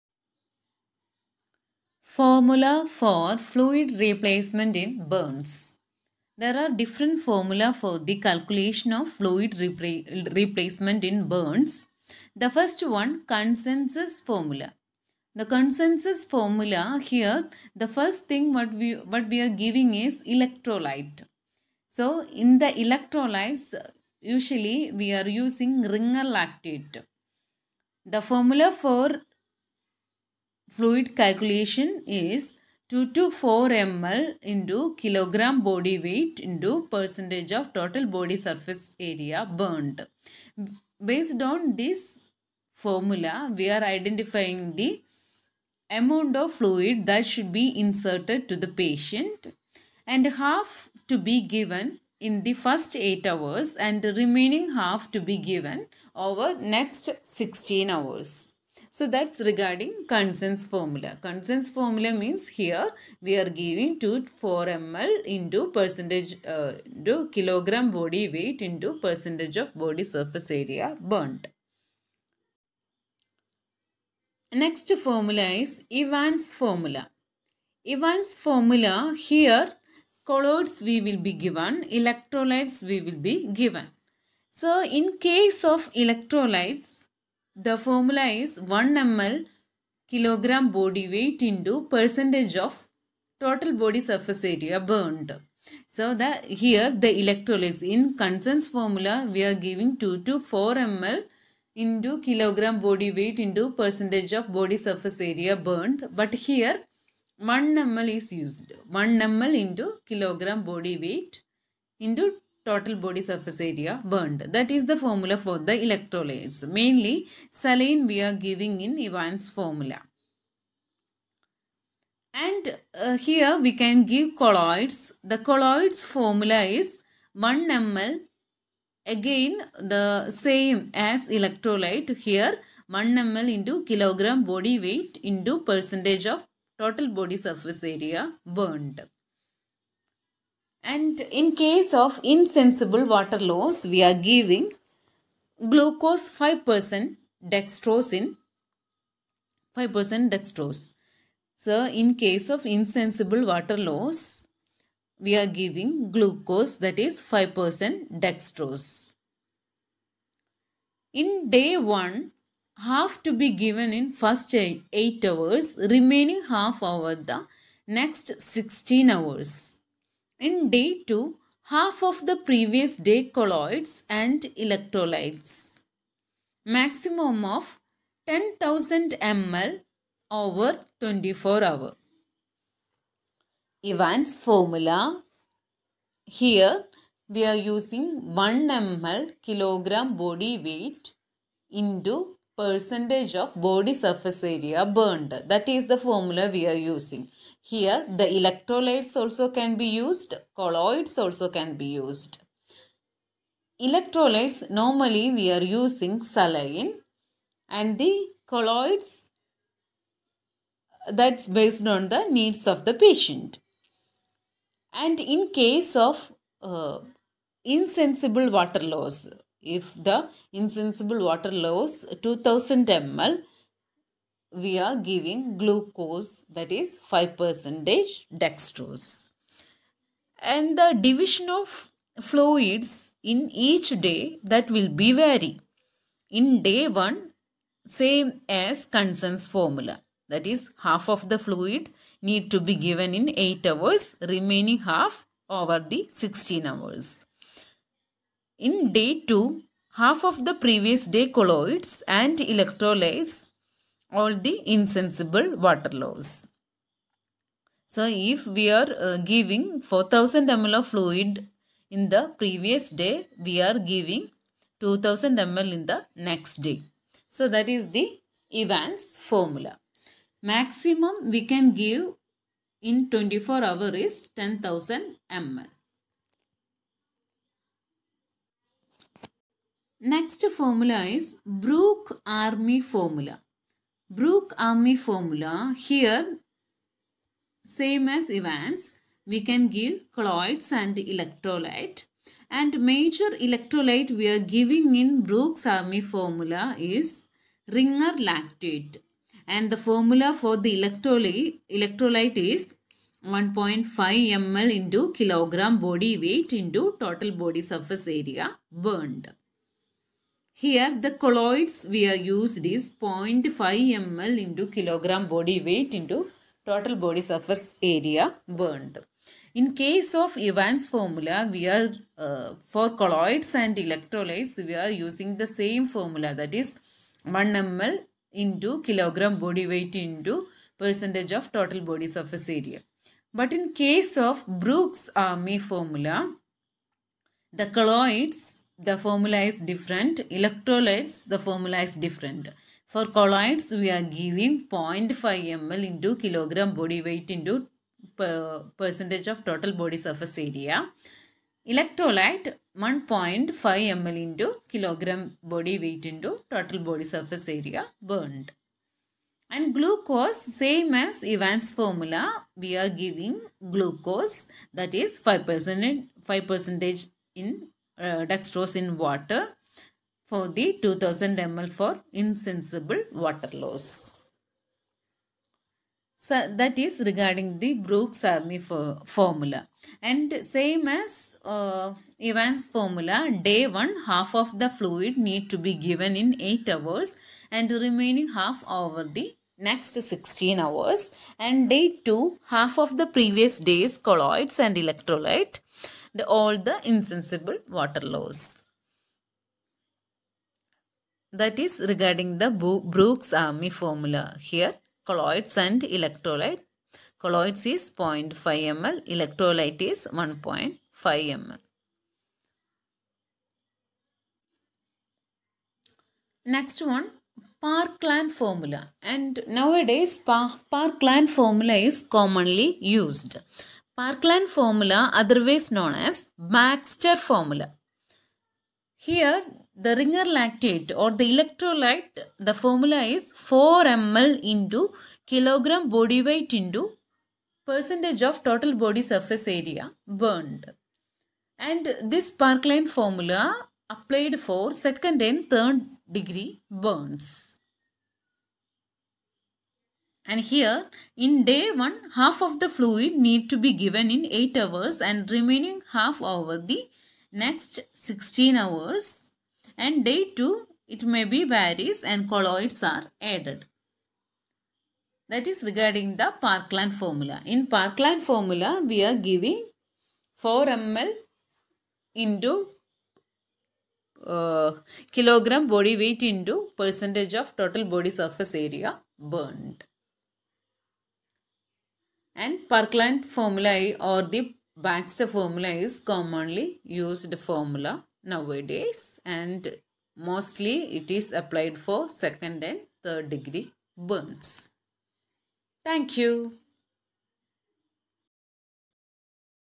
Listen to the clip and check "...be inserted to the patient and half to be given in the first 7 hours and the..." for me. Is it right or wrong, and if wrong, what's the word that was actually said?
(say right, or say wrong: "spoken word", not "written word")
wrong: "8", not "7".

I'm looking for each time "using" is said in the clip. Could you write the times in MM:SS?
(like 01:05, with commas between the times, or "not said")
00:25, 03:07, 03:16, 03:25, 05:24.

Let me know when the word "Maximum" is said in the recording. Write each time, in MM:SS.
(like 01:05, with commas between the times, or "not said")
02:56, 04:30.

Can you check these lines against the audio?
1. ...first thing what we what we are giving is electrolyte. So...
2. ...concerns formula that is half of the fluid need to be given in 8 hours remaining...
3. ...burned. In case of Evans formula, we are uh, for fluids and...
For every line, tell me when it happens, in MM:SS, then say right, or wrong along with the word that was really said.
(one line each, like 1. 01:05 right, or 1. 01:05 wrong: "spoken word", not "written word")
1. 00:17 right
2. 03:58 right
3. 05:18 wrong: "colloids", not "fluids".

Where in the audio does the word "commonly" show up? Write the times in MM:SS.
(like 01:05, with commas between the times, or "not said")
07:02, 08:05.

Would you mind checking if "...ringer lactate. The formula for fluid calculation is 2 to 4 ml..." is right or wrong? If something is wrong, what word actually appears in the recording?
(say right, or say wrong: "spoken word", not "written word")
right.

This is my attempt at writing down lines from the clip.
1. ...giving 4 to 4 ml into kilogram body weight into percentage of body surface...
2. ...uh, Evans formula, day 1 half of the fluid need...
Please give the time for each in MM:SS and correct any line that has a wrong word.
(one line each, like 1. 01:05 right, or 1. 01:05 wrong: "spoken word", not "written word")
1. 01:39 wrong: "2", not "4"
2. 06:21 right.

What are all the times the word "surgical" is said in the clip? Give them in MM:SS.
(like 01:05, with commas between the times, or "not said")
not said.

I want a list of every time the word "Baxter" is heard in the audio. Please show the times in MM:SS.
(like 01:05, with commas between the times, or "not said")
07:06, 08:04.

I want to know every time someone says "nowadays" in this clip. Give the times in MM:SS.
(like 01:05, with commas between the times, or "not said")
06:59, 08:08.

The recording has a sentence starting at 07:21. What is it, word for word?
And this Parkland formula applied for second and third degree burns.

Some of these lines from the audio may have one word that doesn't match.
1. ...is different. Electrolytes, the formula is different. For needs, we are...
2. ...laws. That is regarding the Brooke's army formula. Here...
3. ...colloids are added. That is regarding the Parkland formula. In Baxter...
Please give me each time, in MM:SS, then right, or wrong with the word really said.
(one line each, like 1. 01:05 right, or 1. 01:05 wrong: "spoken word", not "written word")
1. 05:39 wrong: "colloids", not "needs"
2. 06:38 right
3. 07:42 wrong: "Parkland", not "Baxter".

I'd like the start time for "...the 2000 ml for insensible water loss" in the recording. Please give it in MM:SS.
06:10.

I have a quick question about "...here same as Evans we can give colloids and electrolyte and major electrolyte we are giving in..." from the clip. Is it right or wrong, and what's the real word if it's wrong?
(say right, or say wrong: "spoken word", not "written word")
right.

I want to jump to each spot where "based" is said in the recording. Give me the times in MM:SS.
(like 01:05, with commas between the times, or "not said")
00:41, 03:31.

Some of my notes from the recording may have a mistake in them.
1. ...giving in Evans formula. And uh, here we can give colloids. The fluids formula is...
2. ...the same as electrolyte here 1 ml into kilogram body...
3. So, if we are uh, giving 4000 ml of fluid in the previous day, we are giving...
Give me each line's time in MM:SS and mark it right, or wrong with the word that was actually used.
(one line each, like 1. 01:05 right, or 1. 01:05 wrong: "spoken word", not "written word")
1. 01:58 wrong: "colloids", not "fluids"
2. 02:09 right
3. 04:17 right.